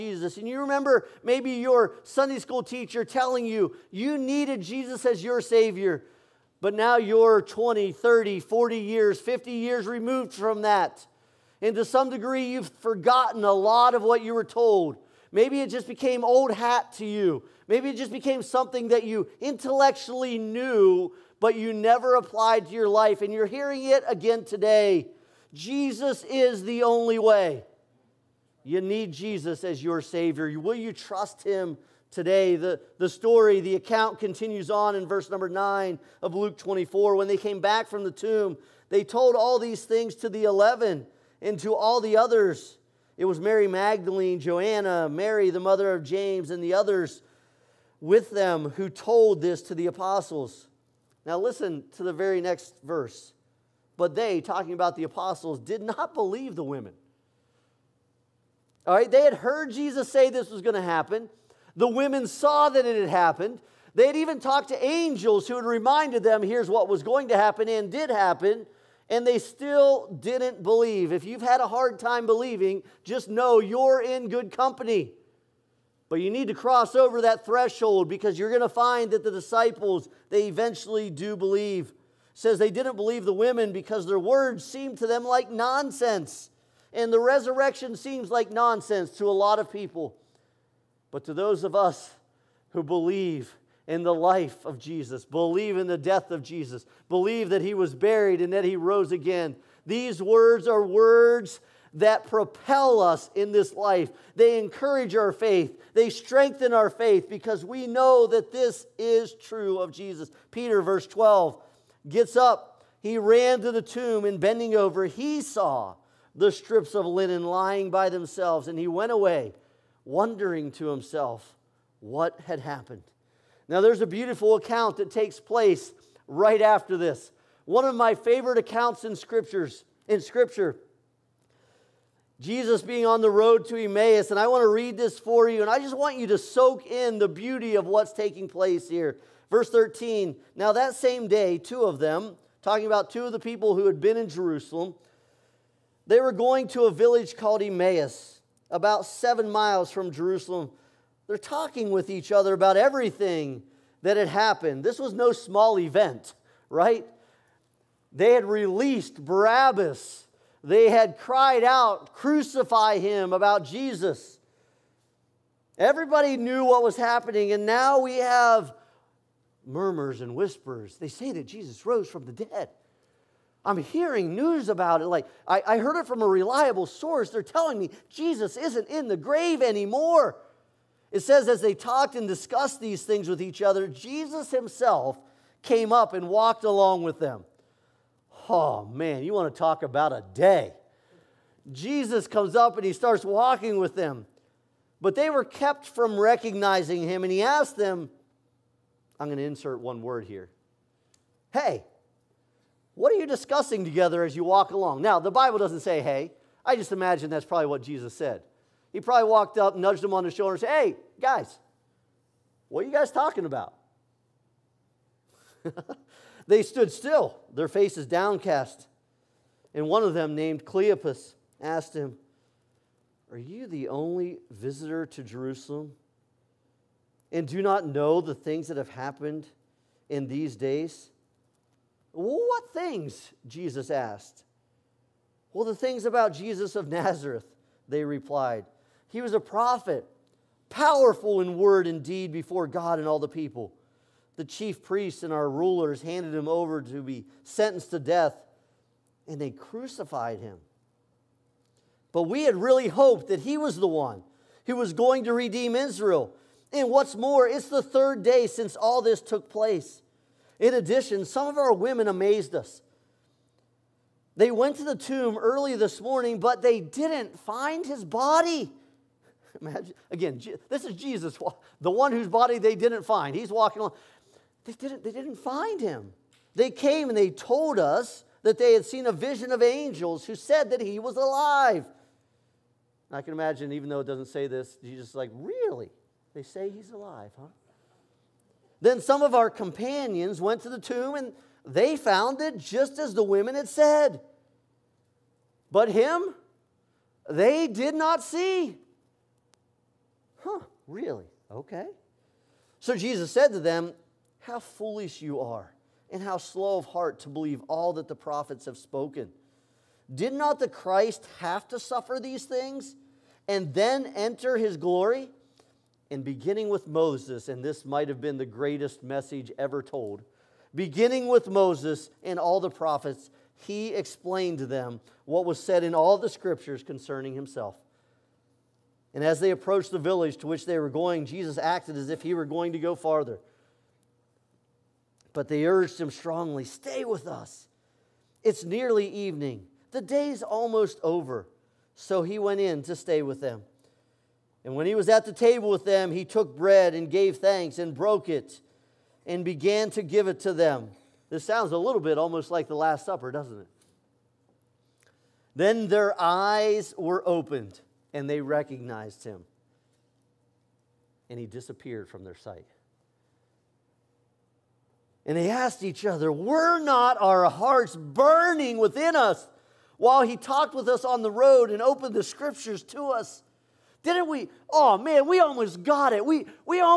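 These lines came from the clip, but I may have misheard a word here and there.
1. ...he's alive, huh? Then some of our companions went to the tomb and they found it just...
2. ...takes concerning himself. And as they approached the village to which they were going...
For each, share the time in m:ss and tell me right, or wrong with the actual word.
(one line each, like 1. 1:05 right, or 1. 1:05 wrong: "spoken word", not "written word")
1. 4:46 right
2. 5:26 wrong: "scriptures", not "takes".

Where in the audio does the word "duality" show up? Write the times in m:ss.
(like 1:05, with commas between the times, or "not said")
not said.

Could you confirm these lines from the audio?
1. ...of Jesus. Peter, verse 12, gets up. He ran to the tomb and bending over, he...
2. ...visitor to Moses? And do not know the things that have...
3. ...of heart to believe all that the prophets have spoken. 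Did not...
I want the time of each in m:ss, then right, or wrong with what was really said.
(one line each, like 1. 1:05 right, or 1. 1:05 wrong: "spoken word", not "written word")
1. 1:49 right
2. 3:44 wrong: "Jerusalem", not "Moses"
3. 5:06 right.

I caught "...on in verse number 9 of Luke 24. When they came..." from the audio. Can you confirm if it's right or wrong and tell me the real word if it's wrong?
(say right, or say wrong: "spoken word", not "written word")
right.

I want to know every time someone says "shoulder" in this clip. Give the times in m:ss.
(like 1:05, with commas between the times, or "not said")
3:30.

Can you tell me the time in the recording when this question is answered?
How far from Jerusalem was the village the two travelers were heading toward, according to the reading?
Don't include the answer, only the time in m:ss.
2:29.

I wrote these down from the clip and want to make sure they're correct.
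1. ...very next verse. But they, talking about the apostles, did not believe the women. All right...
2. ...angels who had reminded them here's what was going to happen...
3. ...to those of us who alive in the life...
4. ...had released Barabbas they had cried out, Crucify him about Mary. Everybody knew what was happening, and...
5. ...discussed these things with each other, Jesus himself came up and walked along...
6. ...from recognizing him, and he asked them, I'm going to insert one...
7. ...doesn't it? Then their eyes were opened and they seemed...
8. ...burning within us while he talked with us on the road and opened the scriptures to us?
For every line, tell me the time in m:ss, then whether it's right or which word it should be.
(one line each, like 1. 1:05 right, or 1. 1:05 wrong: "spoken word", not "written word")
1. 0:52 right
2. 1:04 right
3. 1:31 wrong: "believe", not "alive"
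4. 2:38 wrong: "Jesus", not "Mary"
5. 3:02 right
6. 3:15 right
7. 5:53 wrong: "recognized", not "seemed"
8. 6:07 right.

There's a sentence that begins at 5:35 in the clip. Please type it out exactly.
But they urged him strongly, Stay with us.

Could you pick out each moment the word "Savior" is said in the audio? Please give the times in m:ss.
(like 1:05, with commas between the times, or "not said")
0:05, 0:29.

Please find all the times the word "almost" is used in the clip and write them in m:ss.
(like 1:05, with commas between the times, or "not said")
5:40, 5:52, 6:15.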